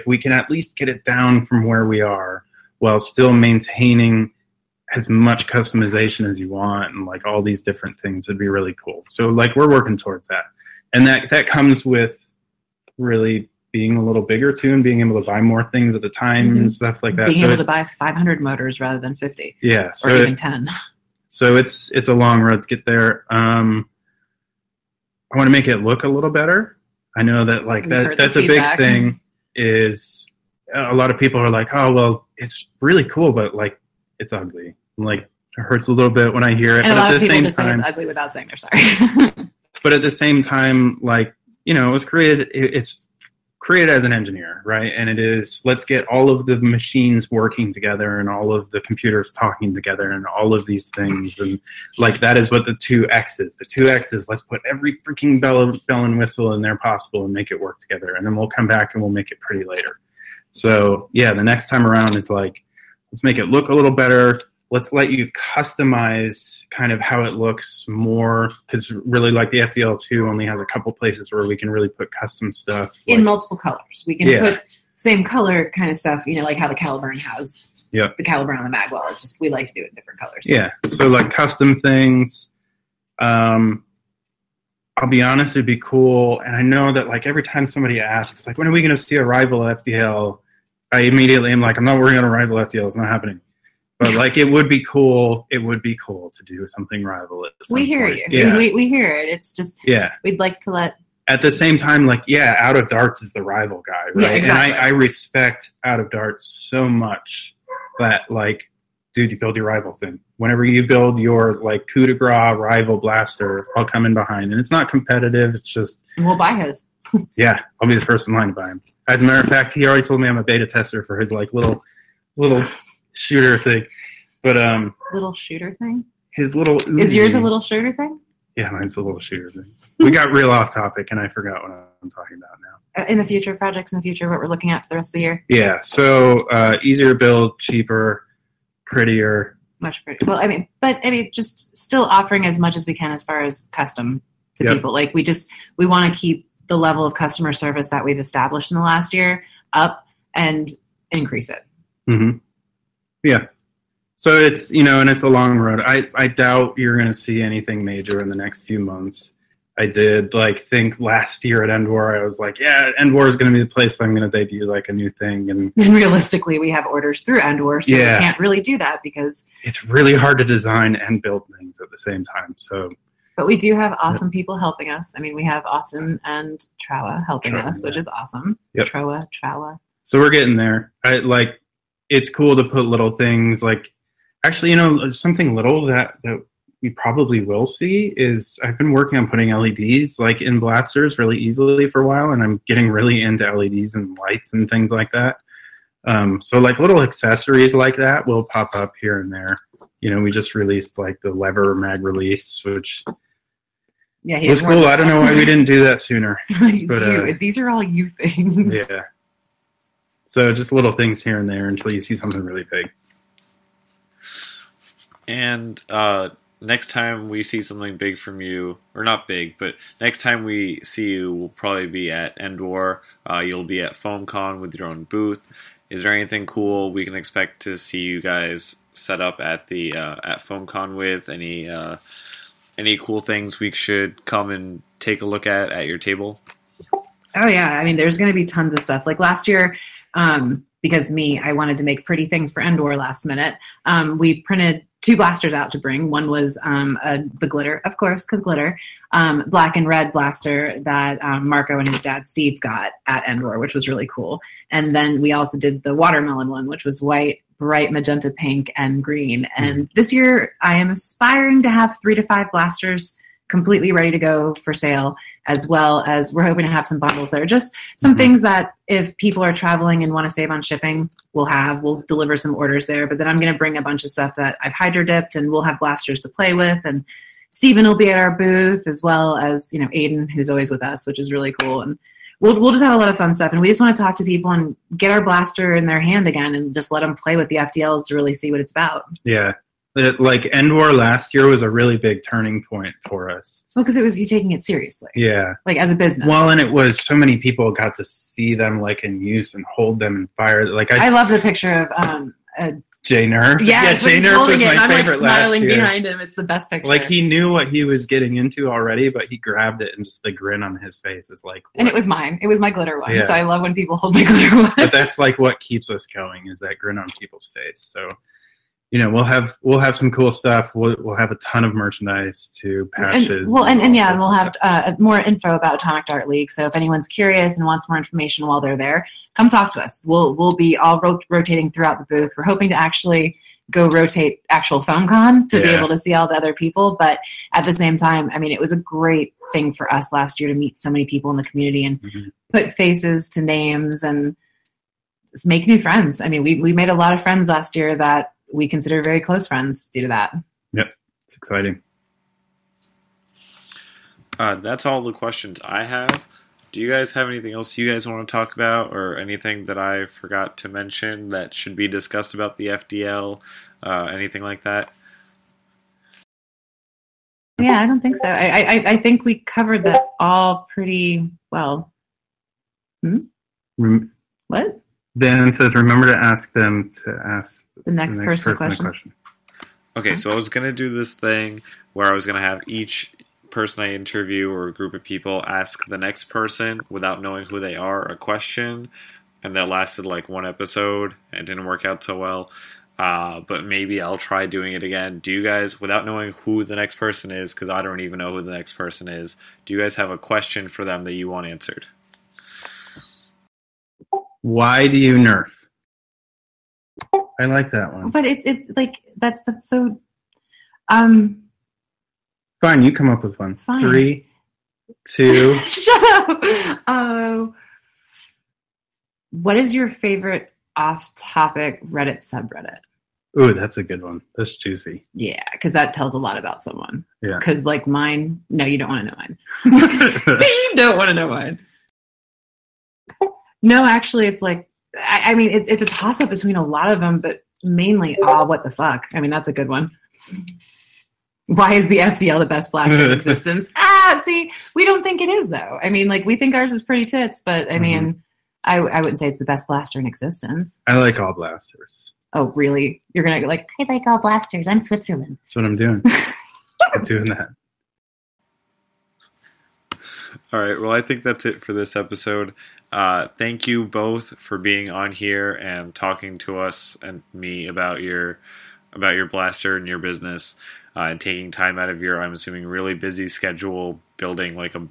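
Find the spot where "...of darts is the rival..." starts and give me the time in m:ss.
1:42.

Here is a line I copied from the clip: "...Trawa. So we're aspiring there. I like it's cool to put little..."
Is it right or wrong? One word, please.
wrong.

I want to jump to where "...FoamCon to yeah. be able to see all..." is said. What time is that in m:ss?
5:34.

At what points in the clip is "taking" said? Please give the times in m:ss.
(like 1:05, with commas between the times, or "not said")
4:54, 7:51.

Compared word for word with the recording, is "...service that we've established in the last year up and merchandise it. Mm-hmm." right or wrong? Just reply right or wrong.
wrong.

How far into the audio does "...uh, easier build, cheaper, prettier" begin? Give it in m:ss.
2:16.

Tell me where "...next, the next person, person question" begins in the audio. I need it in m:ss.
6:17.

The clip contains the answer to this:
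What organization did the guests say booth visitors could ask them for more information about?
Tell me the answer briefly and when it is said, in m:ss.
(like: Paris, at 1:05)
Atomic Dart League, at 5:25.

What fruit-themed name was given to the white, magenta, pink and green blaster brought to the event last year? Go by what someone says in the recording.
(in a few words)
watermelon.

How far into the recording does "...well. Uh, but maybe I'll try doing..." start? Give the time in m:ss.
6:32.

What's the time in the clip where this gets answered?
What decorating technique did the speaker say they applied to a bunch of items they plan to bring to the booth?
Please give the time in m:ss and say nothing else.
4:34.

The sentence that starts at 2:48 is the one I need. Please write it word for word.
we can't really do that because it's really hard to design and build things at the same time.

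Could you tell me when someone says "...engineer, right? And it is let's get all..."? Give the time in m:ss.
0:44.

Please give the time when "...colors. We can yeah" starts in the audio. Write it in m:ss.
1:13.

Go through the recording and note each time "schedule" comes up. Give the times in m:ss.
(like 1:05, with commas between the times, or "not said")
7:53.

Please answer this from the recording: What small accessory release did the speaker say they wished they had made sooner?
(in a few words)
lever mag release.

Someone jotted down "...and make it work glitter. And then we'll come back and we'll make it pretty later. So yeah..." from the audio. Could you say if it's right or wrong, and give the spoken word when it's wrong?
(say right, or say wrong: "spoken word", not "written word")
wrong: "together", not "glitter".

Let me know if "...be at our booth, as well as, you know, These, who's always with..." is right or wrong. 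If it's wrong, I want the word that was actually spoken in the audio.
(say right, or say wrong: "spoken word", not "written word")
wrong: "Aiden", not "These".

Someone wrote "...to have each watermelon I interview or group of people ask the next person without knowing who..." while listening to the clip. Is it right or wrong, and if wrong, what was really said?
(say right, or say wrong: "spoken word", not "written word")
wrong: "person", not "watermelon".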